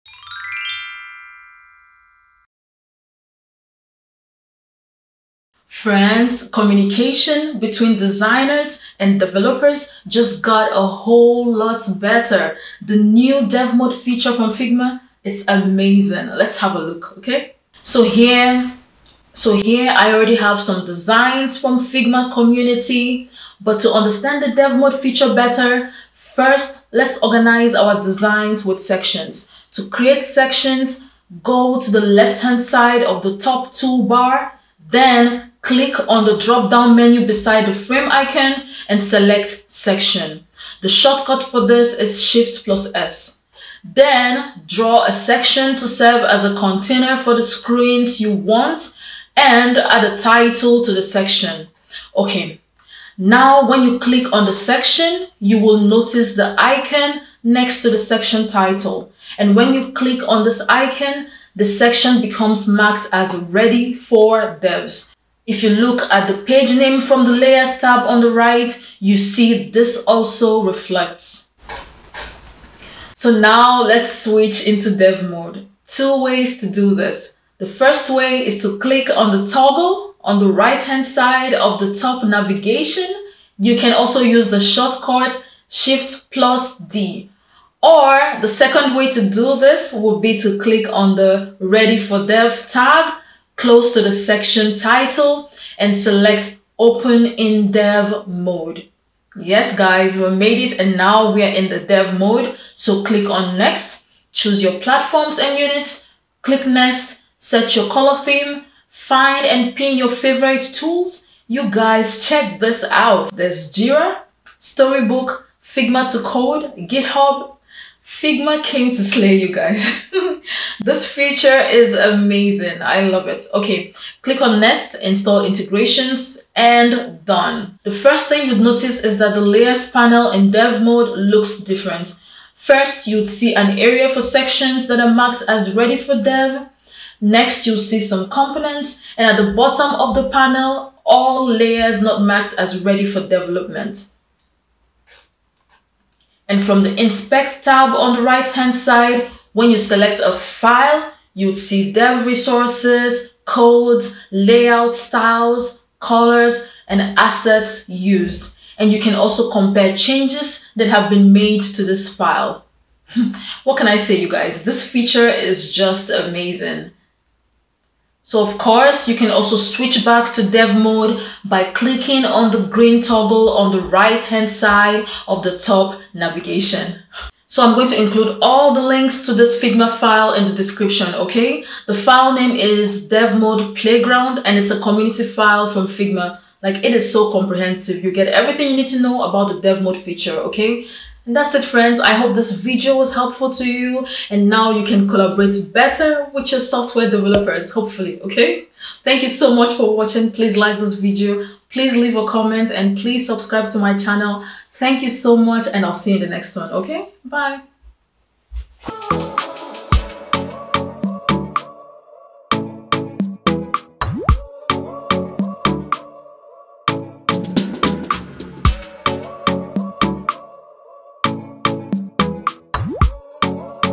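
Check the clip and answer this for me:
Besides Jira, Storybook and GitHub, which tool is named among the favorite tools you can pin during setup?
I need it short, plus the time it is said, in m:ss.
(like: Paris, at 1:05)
Figma to code, at 1:55.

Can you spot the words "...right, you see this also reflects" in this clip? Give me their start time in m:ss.
1:08.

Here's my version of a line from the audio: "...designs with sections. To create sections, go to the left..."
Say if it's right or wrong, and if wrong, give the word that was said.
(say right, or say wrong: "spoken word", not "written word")
right.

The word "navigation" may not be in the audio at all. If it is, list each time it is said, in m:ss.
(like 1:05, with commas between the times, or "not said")
1:22, 2:56.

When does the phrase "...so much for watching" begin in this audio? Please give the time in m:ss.
3:19.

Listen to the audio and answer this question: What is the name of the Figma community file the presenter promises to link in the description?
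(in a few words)
DevMode Playground.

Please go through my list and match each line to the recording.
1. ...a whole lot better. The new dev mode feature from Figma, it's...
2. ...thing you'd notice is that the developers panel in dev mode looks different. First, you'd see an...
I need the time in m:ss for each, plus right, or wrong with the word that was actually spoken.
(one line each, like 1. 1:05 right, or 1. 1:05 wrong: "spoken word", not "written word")
1. 0:10 right
2. 2:08 wrong: "layers", not "developers".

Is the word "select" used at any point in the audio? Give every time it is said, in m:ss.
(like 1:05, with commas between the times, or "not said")
0:39, 1:35, 2:29.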